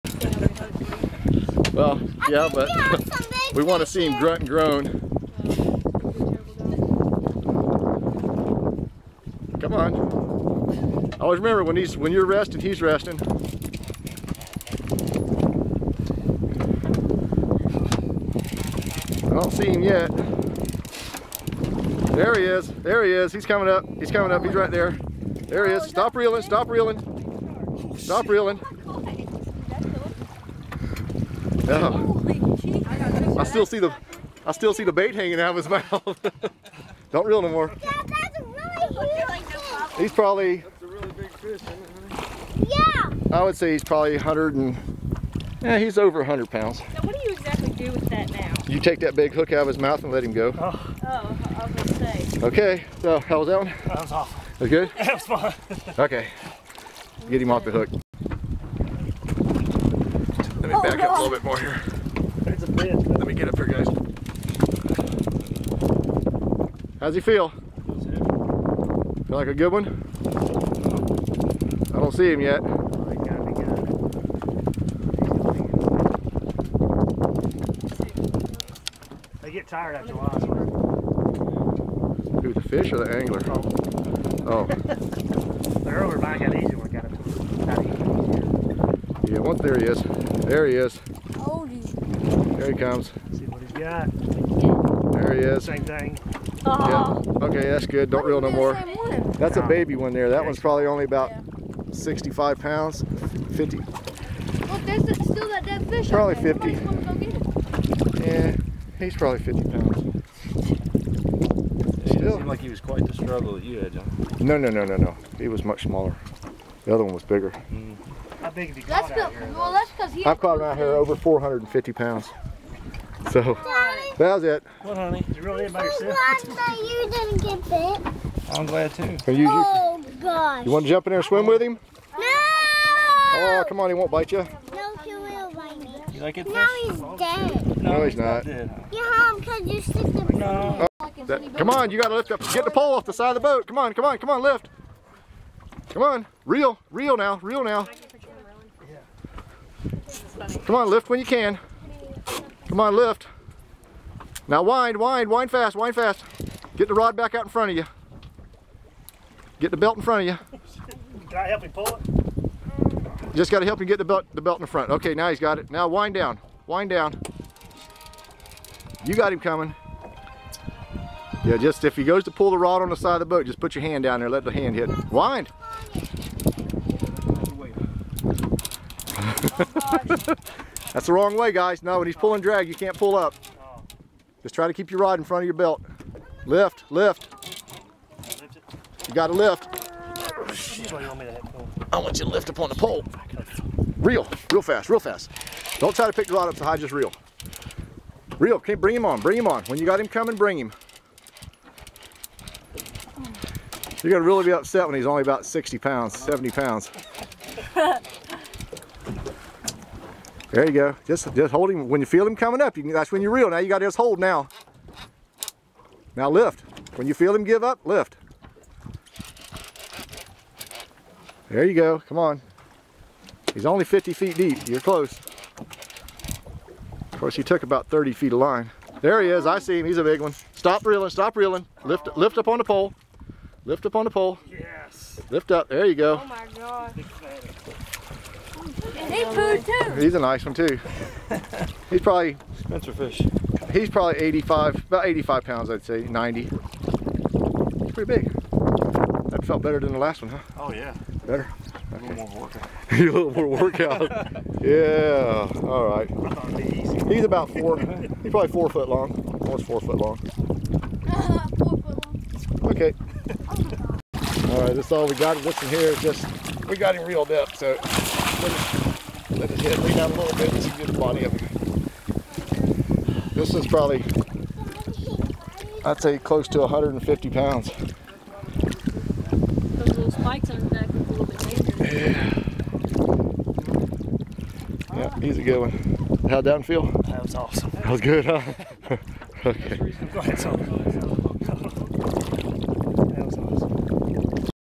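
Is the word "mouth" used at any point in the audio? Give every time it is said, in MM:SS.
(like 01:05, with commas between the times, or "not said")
00:35, 00:49.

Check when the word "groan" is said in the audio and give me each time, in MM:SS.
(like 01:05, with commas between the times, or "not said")
00:04.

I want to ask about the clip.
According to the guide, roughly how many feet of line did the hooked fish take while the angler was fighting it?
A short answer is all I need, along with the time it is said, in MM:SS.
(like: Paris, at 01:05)
30 feet, at 03:47.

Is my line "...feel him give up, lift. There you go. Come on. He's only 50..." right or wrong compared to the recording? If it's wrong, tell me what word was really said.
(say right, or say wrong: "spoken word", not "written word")
right.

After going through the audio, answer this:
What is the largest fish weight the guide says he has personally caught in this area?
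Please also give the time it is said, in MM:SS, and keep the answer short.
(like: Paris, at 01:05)
over 450 pounds, at 02:00.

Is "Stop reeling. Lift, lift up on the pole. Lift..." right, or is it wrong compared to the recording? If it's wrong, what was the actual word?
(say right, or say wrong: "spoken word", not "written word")
right.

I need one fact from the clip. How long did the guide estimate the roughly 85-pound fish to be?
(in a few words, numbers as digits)
almost 4 feet.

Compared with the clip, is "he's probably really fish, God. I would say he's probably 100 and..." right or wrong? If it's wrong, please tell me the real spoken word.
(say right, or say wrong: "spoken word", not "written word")
wrong: "Yeah", not "God".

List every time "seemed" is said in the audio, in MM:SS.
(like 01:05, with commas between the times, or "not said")
01:52.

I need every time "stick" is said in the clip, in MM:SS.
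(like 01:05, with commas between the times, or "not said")
02:19.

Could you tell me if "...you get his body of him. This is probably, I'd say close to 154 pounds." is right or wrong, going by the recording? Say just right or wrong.
wrong.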